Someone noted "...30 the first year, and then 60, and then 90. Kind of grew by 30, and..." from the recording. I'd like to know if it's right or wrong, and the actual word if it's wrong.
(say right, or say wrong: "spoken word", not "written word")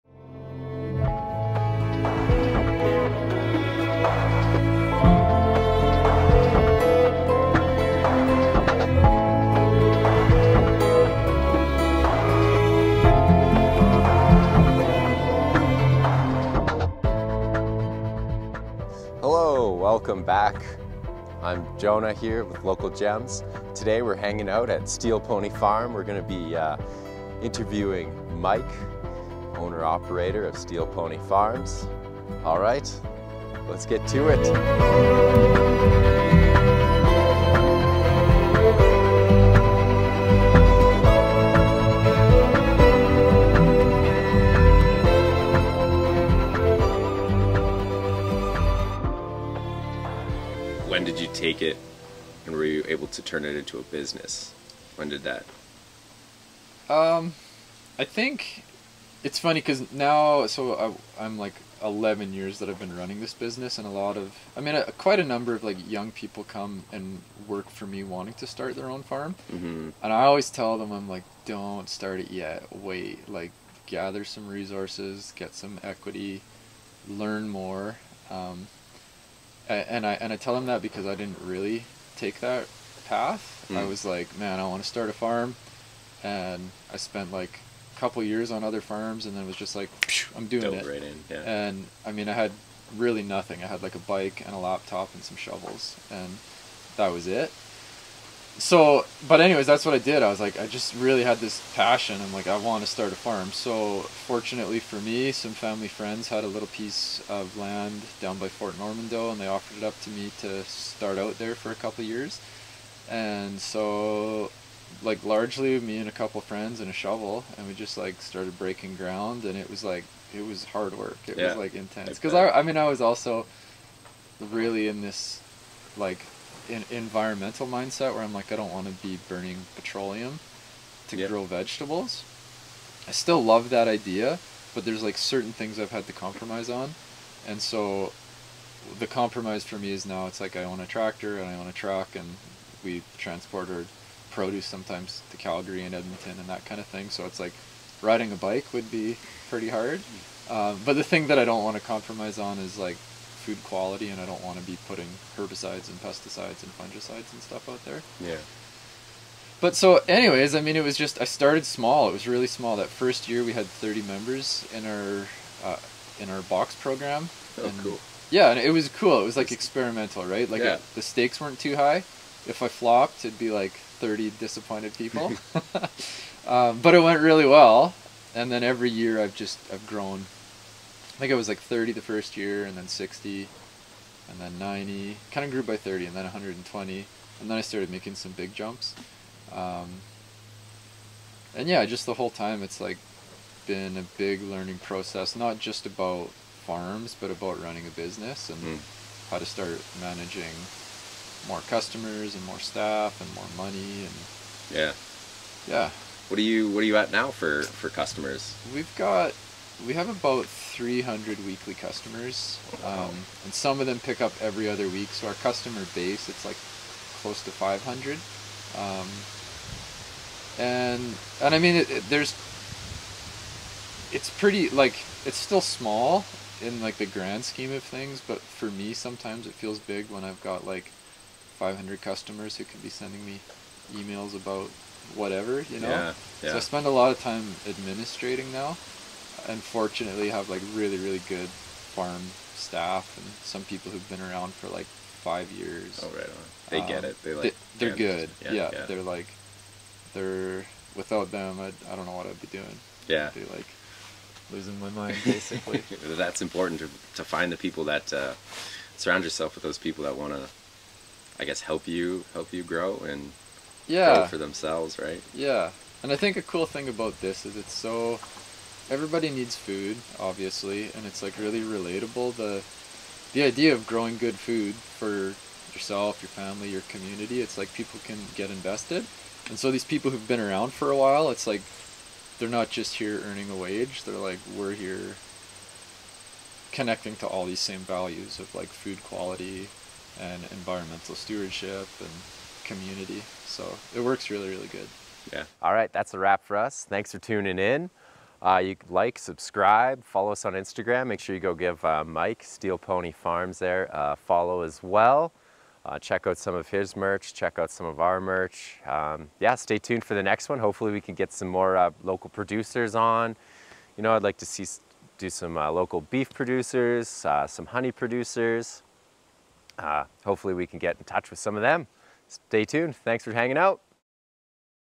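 right.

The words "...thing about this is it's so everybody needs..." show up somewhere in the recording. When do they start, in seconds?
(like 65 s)
266 s.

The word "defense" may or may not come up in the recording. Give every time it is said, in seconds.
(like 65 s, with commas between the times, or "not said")
not said.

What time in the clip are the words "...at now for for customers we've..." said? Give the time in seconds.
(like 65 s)
206 s.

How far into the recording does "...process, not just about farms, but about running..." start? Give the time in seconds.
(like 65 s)
194 s.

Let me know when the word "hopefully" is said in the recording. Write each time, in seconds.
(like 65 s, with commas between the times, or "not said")
310 s, 320 s.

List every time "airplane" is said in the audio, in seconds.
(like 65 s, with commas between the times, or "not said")
not said.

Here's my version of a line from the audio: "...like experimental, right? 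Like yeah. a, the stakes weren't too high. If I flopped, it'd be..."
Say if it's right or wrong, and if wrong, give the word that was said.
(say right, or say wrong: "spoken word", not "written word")
right.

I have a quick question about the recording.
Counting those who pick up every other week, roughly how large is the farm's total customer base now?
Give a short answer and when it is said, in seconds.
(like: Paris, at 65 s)
500, at 217 s.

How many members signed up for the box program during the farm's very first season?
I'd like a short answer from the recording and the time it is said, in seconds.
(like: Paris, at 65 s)
30, at 163 s.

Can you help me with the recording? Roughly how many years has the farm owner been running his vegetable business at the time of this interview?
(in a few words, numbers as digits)
11.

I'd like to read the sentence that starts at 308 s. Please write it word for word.
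Um, yeah, stay tuned for the next one.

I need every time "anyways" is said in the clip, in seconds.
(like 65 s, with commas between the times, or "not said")
99 s, 160 s.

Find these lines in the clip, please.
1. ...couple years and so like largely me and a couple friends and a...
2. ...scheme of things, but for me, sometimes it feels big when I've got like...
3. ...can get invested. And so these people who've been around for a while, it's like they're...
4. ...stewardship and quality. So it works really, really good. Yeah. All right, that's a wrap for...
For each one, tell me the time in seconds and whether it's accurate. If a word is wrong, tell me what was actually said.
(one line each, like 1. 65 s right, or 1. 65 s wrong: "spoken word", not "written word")
1. 111 s right
2. 227 s right
3. 278 s right
4. 291 s wrong: "community", not "quality".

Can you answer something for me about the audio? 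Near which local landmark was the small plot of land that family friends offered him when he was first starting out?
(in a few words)
Fort Normandeau.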